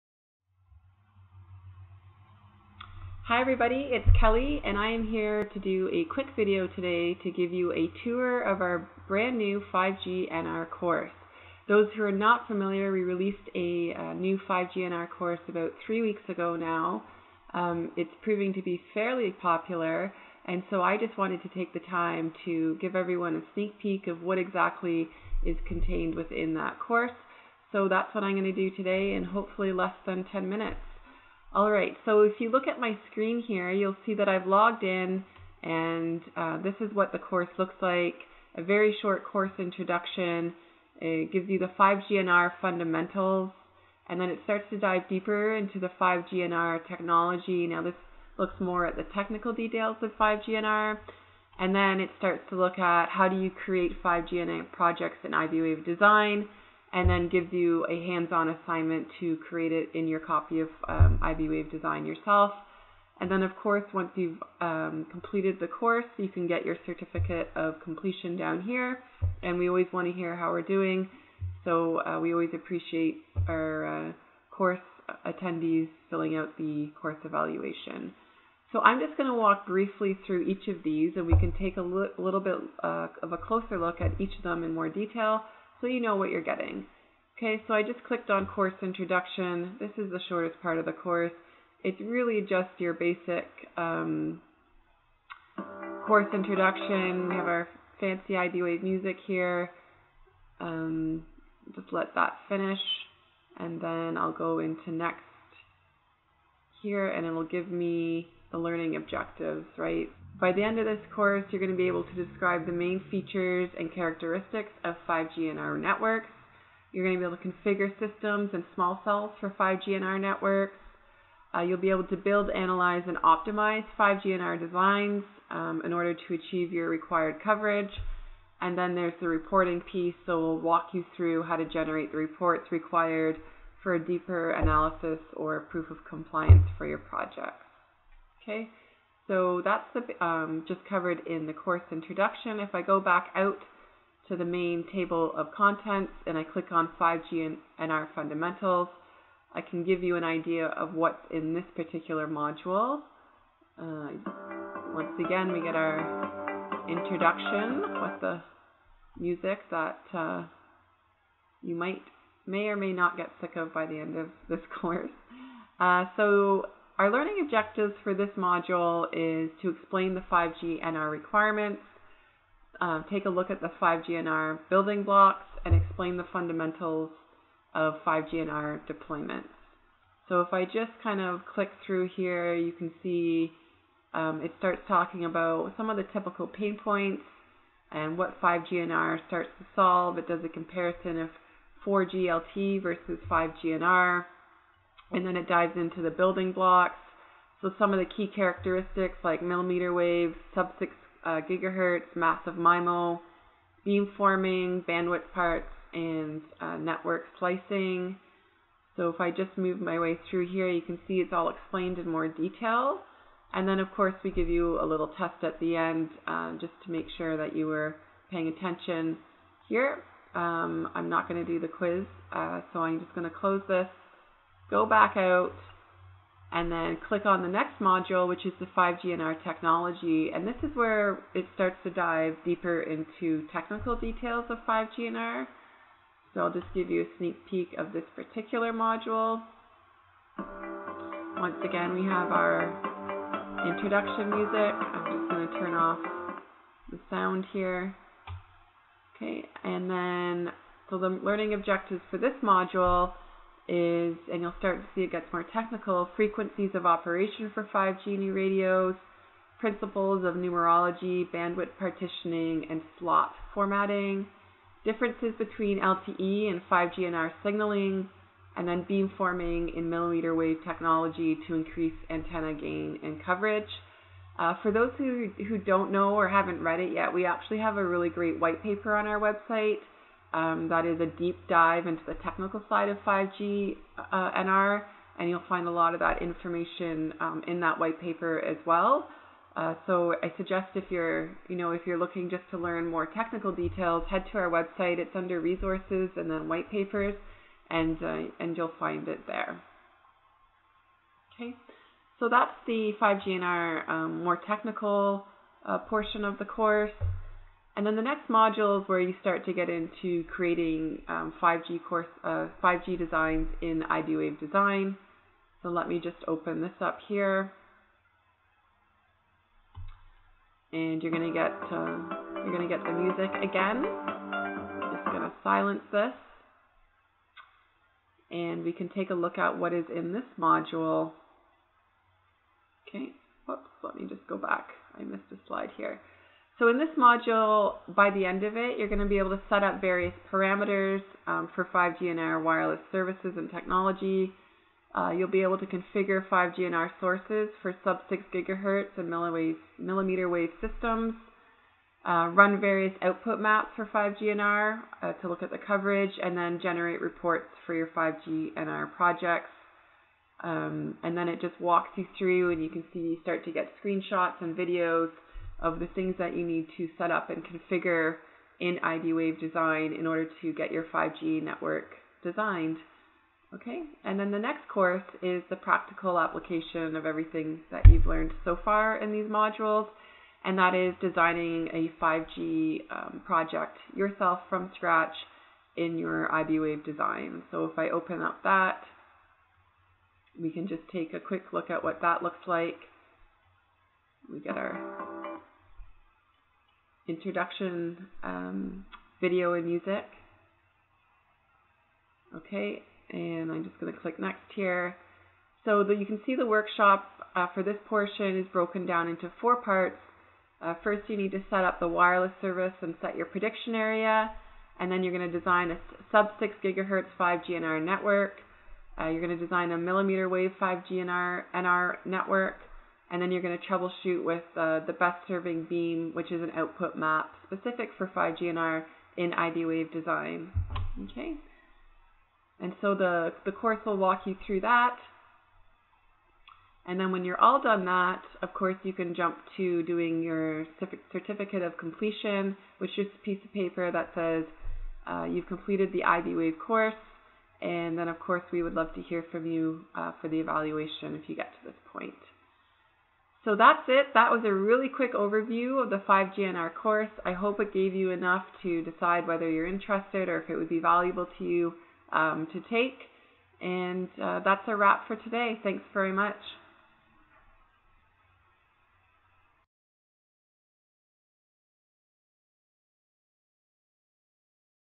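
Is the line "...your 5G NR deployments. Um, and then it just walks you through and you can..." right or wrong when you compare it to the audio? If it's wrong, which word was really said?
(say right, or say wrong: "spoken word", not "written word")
wrong: "projects", not "deployments".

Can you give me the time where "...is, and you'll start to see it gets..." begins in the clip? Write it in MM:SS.
04:13.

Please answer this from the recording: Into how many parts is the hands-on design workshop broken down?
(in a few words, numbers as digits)
4.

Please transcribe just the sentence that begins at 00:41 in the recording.
It gives you the 5GNR fundamentals and then it starts to dive deeper into the 5GNR technology.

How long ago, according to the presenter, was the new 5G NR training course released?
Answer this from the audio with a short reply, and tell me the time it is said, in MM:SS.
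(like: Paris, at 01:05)
3 weeks, at 00:15.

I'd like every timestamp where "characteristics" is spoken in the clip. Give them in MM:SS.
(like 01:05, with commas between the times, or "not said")
01:53, 03:18.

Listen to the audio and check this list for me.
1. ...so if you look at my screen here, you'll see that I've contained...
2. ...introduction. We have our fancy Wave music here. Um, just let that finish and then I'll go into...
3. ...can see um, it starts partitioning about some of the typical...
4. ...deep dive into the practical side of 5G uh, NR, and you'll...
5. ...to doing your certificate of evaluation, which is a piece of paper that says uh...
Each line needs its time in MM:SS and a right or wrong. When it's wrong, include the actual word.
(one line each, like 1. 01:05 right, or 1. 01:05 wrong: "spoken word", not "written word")
1. 00:32 wrong: "logged", not "contained"
2. 01:36 right
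3. 03:02 wrong: "talking", not "partitioning"
4. 04:41 wrong: "technical", not "practical"
5. 07:19 wrong: "completion", not "evaluation".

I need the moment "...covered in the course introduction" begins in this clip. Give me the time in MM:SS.
02:20.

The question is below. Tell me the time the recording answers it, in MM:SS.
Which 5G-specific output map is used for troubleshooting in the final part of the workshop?
07:04.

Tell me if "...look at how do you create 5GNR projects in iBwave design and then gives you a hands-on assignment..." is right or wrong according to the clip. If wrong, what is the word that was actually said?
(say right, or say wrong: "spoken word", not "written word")
right.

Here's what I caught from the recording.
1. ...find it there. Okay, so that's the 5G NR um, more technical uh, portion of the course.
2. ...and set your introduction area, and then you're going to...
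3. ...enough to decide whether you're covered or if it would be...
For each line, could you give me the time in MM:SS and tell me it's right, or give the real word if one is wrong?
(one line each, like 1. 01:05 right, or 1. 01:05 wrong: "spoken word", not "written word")
1. 04:58 right
2. 06:52 wrong: "prediction", not "introduction"
3. 07:38 wrong: "interested", not "covered".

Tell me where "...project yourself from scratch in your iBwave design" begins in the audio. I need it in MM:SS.
06:23.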